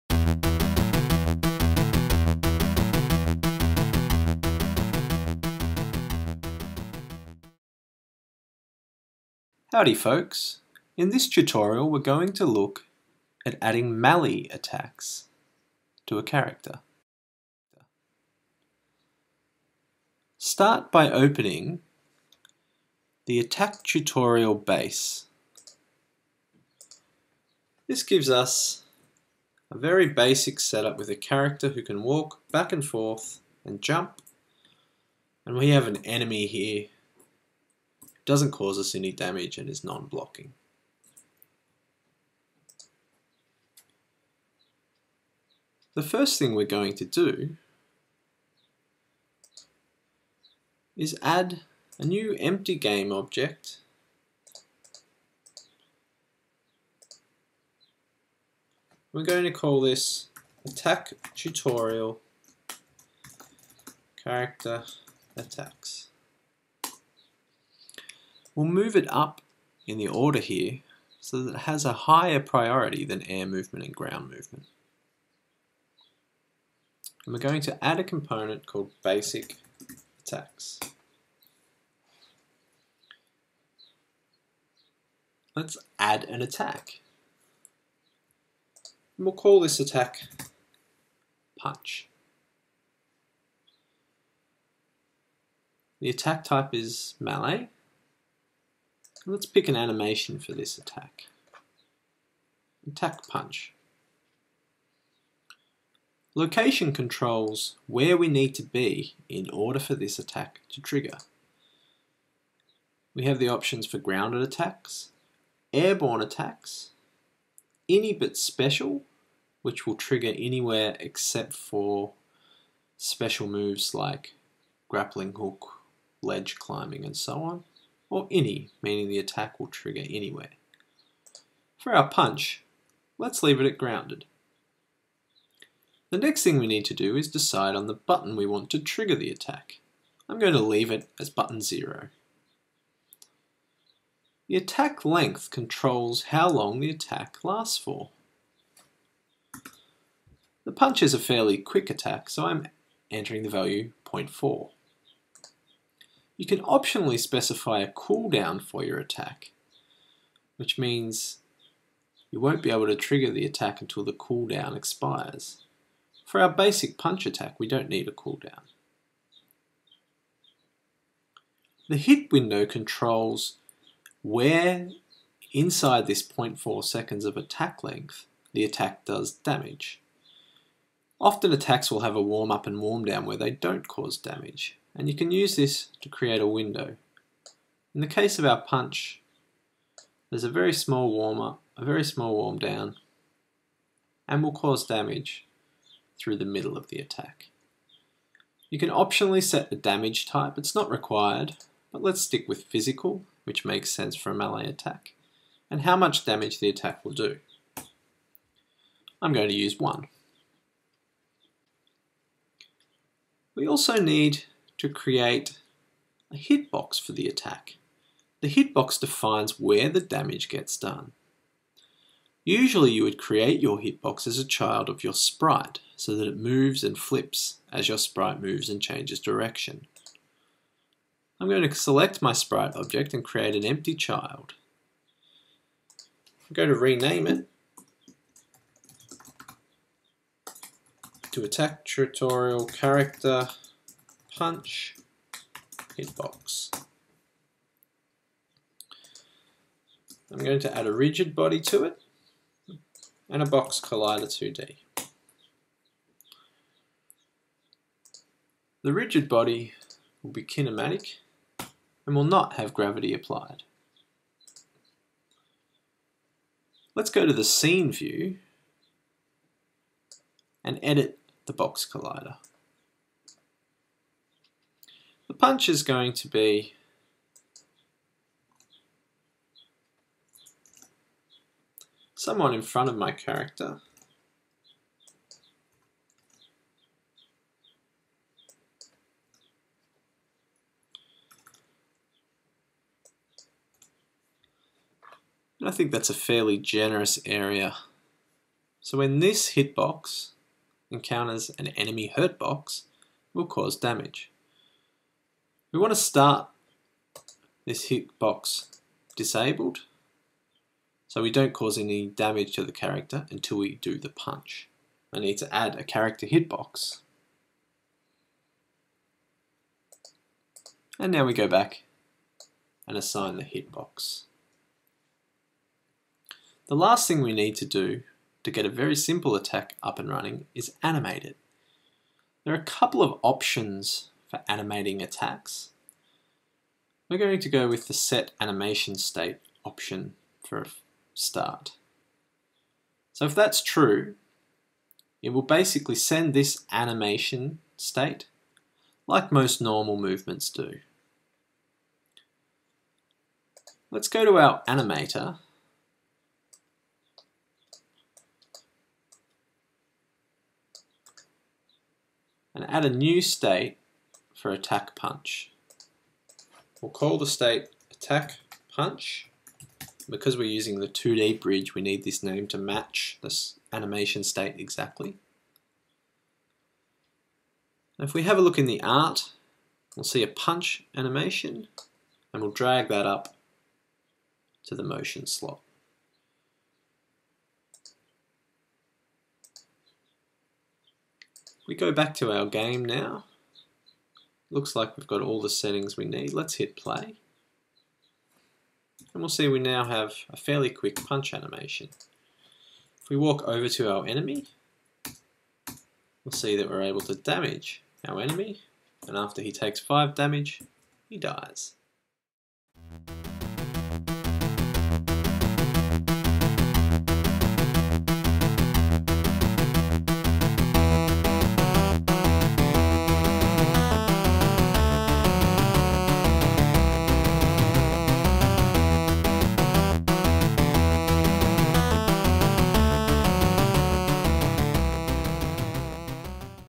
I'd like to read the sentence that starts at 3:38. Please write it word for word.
The hitbox defines where the damage gets done.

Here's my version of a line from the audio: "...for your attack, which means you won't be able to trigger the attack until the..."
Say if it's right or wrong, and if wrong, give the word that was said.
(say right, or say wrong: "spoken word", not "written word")
right.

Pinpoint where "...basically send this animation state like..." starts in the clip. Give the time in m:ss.
5:45.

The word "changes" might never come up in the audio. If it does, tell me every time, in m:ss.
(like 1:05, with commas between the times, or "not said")
3:48.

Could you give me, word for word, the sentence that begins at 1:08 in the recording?
We'll move it up in the order here so that it has a higher priority than air movement and ground movement.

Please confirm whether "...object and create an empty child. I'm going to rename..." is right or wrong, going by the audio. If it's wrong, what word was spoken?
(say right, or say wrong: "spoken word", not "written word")
right.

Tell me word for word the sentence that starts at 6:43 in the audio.
If we walk over to our enemy, we'll see that we're able to damage our enemy.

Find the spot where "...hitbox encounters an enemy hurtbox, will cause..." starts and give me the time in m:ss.
4:59.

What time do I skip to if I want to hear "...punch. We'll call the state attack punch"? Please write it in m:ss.
6:04.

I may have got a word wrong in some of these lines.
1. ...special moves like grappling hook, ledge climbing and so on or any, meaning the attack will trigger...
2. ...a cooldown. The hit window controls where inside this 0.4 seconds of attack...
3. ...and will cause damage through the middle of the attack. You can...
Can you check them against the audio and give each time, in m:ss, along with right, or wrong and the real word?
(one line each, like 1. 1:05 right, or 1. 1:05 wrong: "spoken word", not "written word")
1. 2:02 right
2. 2:48 right
3. 3:14 right.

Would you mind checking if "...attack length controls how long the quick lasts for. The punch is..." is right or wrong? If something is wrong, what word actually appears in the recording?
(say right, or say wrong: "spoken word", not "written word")
wrong: "attack", not "quick".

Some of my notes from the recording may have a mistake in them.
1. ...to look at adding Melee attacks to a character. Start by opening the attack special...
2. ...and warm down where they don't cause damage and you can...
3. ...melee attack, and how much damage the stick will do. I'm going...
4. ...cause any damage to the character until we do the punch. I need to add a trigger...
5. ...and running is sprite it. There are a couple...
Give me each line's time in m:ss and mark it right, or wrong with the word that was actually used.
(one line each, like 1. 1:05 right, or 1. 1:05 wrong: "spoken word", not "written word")
1. 0:12 wrong: "tutorial", not "special"
2. 3:02 right
3. 3:24 wrong: "attack", not "stick"
4. 5:11 wrong: "character", not "trigger"
5. 5:29 wrong: "animate", not "sprite".